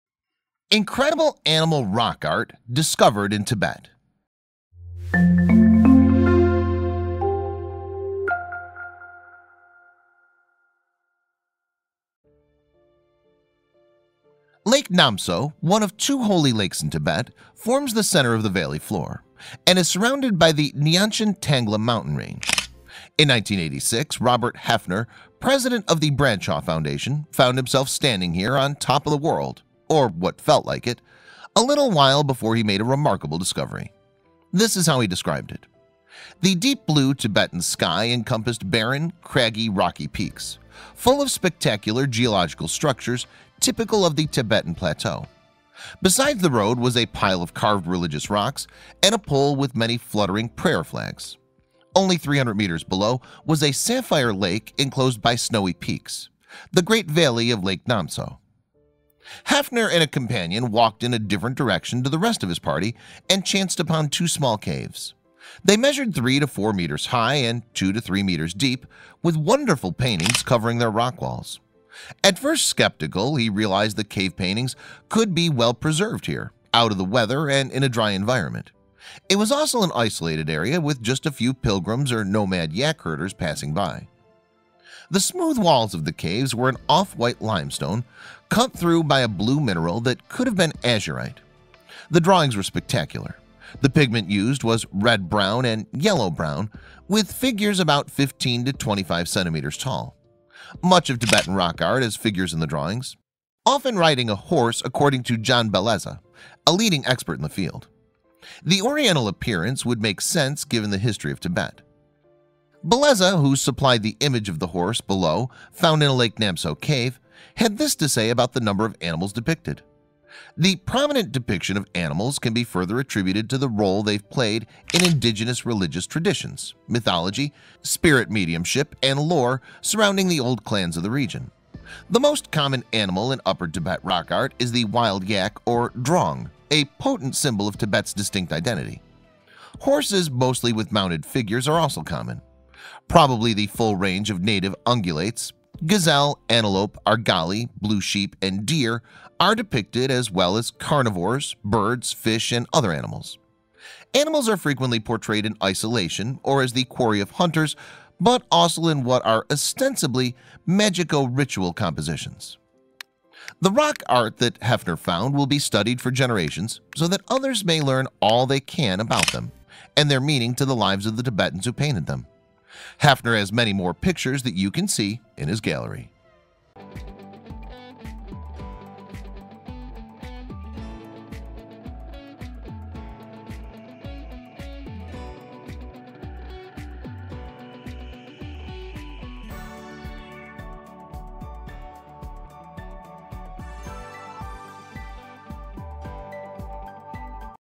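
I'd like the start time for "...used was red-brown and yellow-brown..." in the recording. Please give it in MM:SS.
01:34.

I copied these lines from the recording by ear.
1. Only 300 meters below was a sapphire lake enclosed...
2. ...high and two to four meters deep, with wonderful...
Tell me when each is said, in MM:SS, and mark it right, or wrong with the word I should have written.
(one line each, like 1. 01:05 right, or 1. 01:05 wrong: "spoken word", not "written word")
1. 00:51 right
2. 01:07 wrong: "three", not "four".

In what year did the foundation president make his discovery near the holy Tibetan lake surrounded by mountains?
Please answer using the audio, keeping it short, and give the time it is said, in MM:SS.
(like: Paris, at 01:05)
1986, at 00:23.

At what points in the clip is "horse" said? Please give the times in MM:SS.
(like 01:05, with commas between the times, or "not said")
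01:44, 01:54, 02:19.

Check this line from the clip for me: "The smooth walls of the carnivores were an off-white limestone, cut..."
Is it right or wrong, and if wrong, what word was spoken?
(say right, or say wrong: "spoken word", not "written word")
wrong: "caves", not "carnivores".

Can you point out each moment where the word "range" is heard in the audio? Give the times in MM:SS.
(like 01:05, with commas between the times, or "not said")
00:22, 02:23.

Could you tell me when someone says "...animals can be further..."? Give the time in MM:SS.
02:01.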